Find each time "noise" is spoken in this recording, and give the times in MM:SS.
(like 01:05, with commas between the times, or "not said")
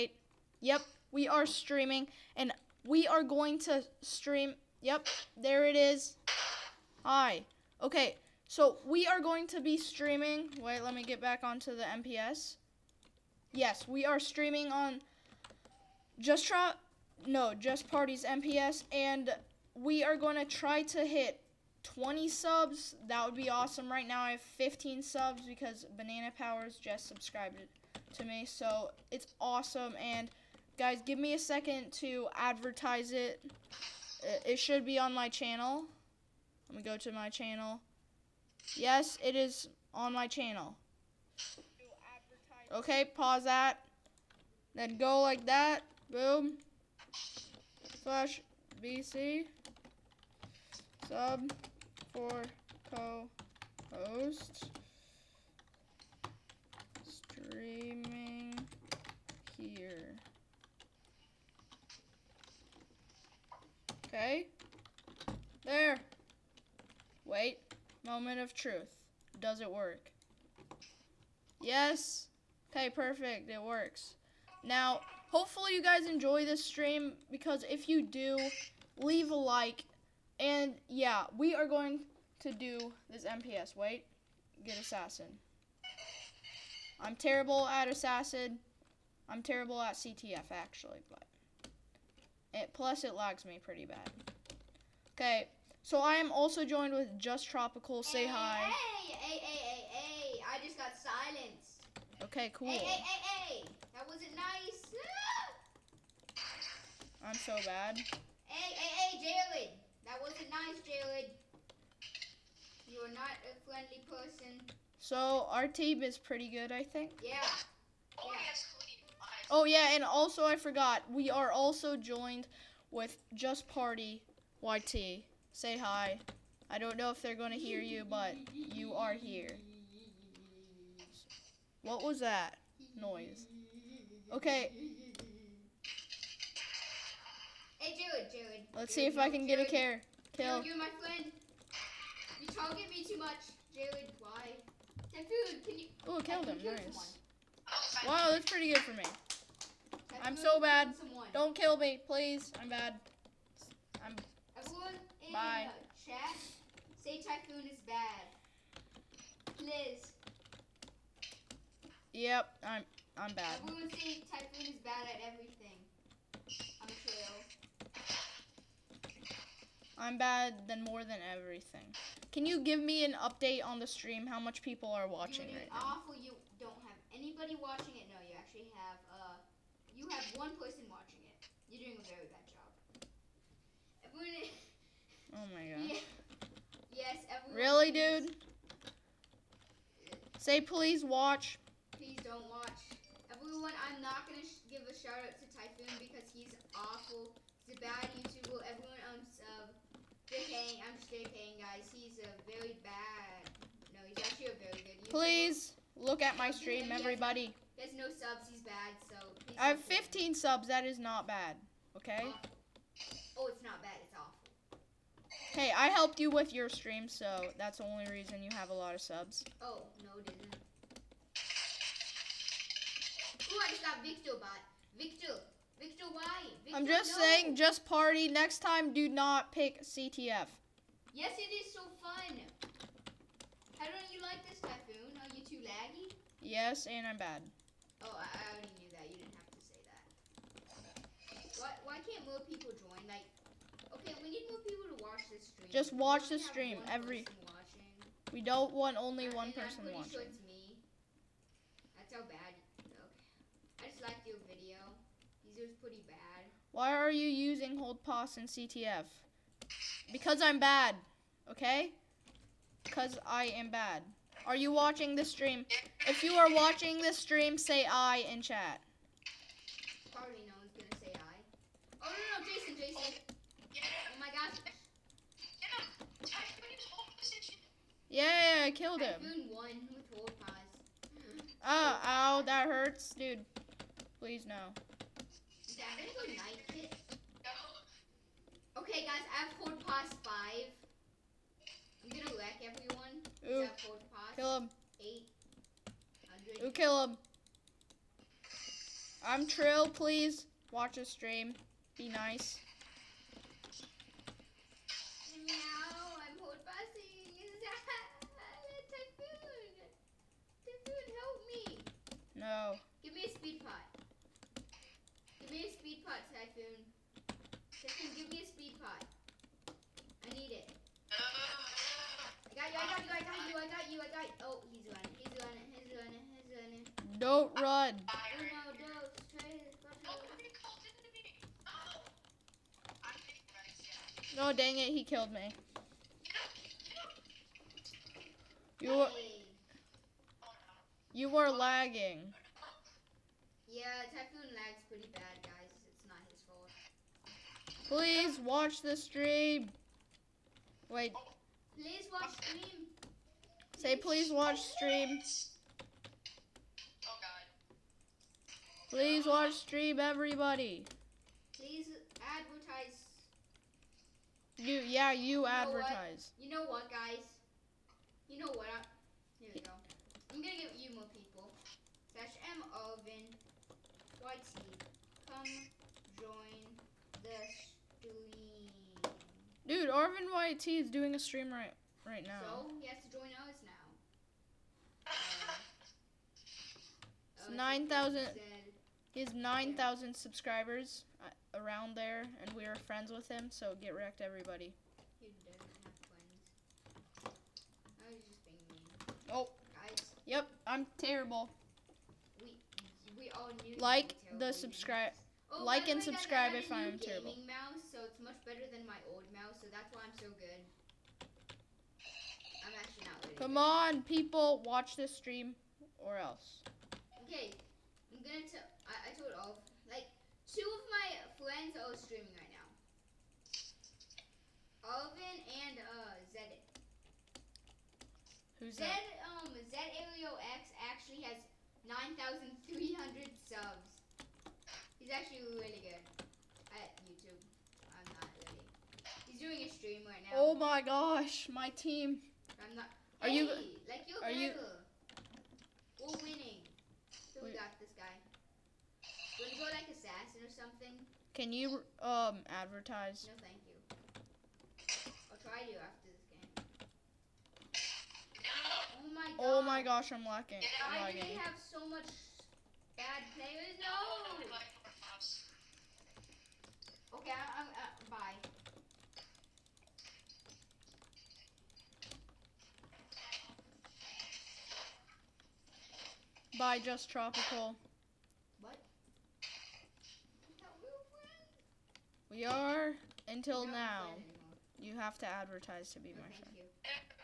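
02:12.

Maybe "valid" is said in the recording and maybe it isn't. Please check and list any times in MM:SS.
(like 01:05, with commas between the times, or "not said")
not said.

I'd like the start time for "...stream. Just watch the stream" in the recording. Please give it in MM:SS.
04:05.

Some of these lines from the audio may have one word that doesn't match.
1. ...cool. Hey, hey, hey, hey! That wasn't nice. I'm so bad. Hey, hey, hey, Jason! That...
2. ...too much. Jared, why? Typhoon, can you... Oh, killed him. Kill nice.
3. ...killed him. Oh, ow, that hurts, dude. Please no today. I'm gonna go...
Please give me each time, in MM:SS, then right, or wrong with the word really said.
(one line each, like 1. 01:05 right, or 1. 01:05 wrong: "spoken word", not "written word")
1. 01:42 wrong: "Jalen", not "Jason"
2. 02:23 right
3. 04:38 right.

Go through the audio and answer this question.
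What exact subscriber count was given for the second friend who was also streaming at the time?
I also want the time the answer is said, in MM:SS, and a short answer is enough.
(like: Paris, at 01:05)
9,300, at 07:12.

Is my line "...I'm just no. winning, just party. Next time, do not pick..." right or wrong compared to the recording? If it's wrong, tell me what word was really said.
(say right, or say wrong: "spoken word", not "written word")
wrong: "saying", not "winning".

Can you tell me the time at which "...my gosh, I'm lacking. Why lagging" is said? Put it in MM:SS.
07:39.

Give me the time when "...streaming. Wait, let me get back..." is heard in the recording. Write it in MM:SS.
00:09.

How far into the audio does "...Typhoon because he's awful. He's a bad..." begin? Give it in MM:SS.
03:15.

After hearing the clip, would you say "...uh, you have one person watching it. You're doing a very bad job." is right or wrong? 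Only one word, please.
right.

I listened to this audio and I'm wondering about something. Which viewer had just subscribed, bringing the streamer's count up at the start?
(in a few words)
Banana Powers.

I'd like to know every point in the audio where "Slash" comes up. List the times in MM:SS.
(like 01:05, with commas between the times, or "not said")
00:48, 06:12.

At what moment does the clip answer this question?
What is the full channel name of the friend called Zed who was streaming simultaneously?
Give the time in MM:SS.
07:09.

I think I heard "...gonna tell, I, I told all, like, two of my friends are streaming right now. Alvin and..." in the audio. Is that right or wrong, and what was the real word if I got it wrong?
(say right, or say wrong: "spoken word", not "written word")
right.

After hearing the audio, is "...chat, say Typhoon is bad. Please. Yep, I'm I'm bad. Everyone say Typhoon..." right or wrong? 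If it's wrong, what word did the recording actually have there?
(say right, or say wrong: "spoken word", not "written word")
right.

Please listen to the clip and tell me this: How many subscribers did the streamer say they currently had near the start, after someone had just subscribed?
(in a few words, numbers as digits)
15.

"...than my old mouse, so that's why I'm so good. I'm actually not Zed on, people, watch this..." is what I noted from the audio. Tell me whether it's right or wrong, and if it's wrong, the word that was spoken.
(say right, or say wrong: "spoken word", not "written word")
wrong: "Come", not "Zed".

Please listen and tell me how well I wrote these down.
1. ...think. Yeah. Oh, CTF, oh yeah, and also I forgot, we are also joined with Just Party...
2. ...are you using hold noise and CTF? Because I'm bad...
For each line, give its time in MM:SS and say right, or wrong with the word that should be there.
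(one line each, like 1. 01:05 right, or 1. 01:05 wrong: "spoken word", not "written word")
1. 01:56 wrong: "Yes", not "CTF"
2. 04:16 wrong: "pause", not "noise".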